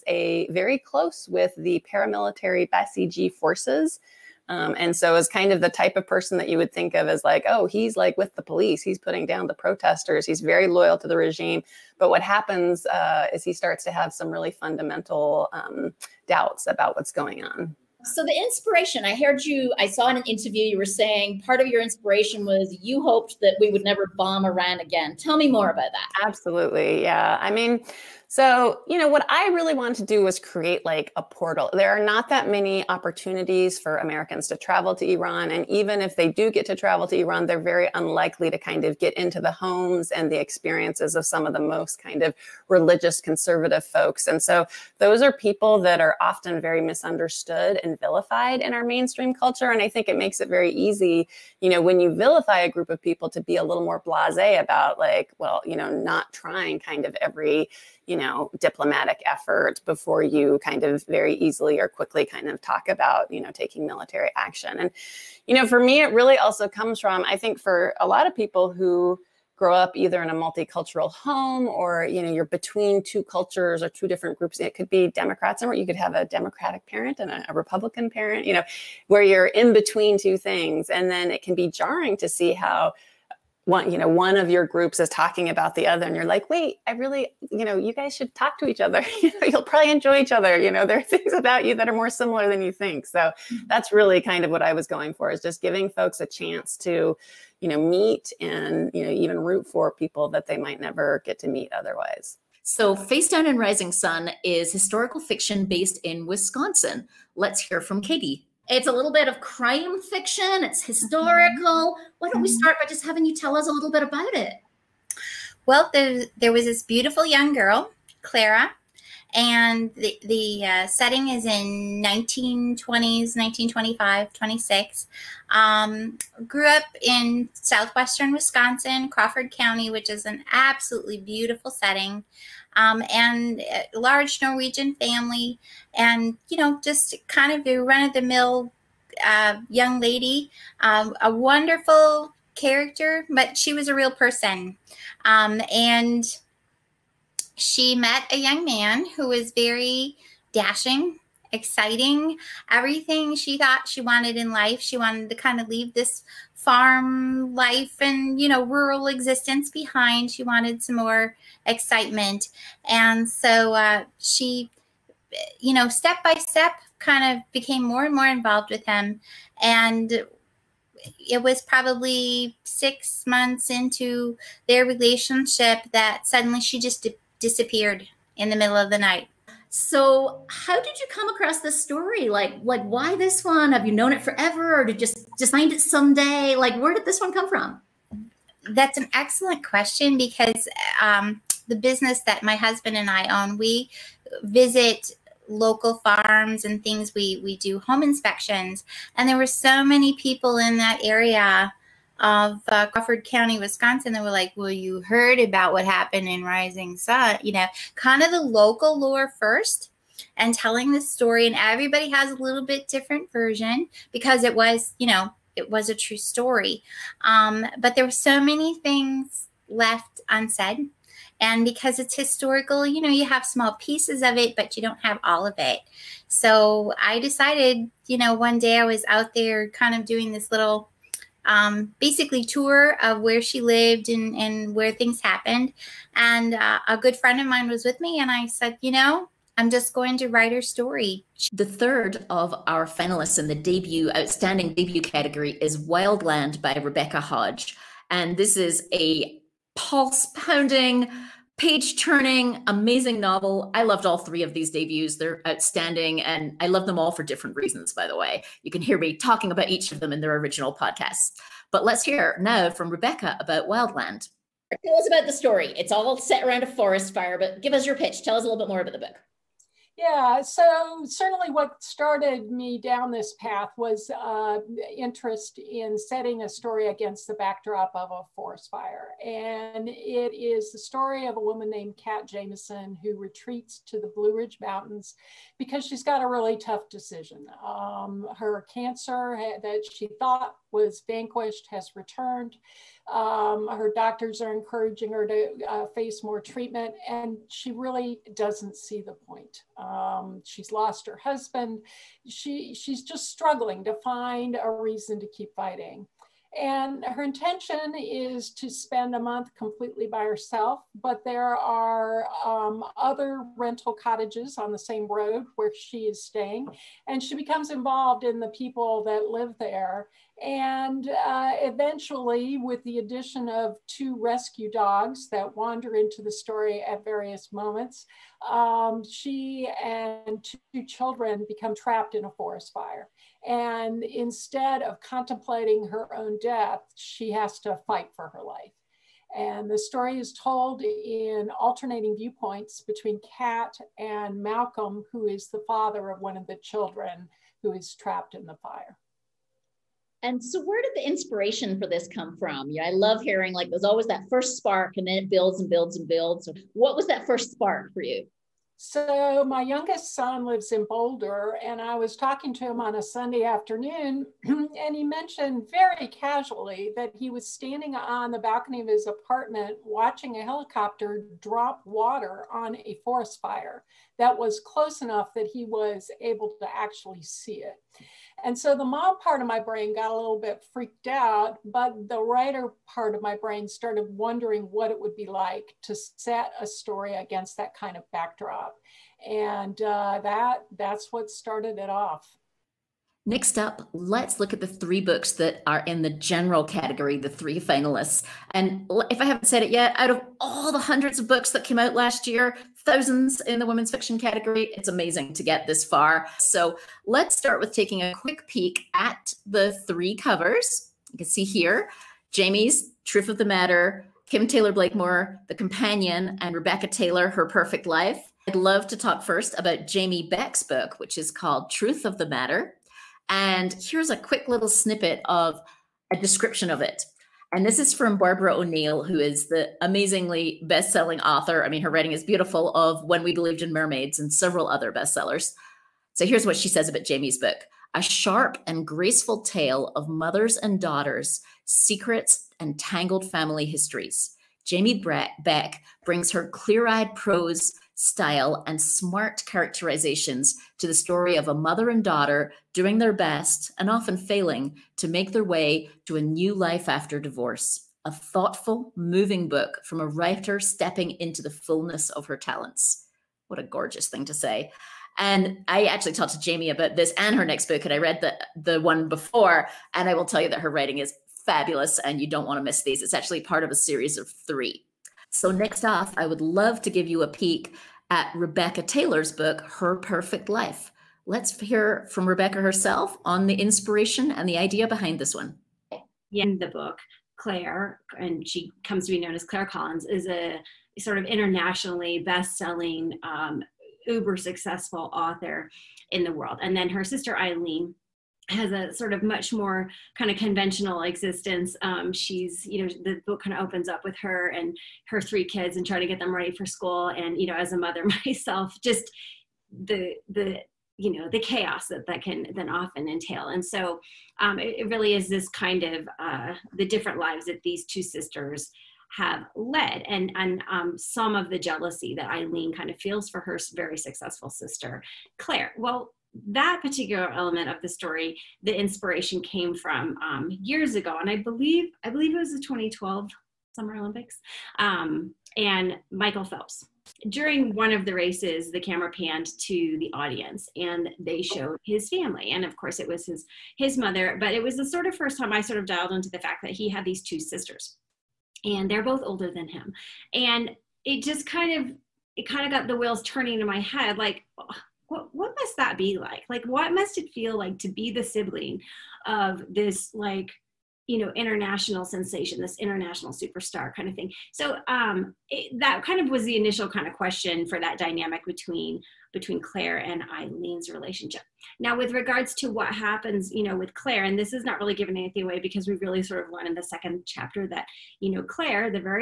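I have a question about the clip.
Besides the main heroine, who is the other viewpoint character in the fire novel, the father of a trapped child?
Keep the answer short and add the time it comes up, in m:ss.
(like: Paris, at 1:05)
Malcolm, at 5:44.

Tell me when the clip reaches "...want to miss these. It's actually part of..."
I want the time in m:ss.
7:52.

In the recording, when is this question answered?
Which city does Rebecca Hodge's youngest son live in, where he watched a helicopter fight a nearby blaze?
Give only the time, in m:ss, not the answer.
6:00.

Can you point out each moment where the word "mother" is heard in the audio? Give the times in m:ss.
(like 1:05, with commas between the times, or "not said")
7:20, 7:31, 8:27, 9:03.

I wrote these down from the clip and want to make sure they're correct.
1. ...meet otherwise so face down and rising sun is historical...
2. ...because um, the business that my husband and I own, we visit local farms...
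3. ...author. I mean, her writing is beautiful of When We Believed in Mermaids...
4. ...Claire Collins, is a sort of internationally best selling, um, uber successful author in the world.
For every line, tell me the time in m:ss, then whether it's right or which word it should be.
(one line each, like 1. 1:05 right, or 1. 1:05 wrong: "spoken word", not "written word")
1. 1:41 right
2. 3:10 right
3. 7:11 right
4. 8:09 right.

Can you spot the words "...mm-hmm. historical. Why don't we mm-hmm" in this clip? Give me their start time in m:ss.
1:50.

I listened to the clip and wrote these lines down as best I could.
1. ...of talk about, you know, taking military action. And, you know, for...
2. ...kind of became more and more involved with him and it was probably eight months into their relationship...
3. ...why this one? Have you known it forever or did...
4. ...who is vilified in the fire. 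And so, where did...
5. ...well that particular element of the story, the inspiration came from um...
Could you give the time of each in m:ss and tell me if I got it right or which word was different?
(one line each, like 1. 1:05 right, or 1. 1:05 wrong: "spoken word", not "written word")
1. 1:02 right
2. 2:46 wrong: "six", not "eight"
3. 3:02 right
4. 5:47 wrong: "trapped", not "vilified"
5. 8:45 right.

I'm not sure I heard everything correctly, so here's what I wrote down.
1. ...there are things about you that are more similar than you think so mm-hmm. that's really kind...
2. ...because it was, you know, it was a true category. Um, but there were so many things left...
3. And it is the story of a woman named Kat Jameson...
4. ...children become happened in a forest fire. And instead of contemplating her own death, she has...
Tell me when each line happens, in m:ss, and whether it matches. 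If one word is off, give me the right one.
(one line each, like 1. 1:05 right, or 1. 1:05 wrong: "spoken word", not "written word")
1. 1:30 right
2. 3:34 wrong: "story", not "category"
3. 4:39 right
4. 5:30 wrong: "trapped", not "happened".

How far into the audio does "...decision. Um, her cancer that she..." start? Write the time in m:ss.
4:46.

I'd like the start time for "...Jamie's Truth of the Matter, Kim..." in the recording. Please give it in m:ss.
6:52.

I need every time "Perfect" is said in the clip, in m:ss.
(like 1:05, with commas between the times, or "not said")
6:57, 7:59.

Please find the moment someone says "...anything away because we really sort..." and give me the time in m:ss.
9:35.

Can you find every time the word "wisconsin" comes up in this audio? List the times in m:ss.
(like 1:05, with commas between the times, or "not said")
1:46, 2:08, 3:23.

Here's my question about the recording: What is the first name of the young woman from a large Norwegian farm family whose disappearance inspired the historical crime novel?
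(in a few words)
Clara.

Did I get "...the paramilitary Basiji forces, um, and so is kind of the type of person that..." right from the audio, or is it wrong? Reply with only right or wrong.
right.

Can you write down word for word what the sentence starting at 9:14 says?
Oh, what, what must that be like?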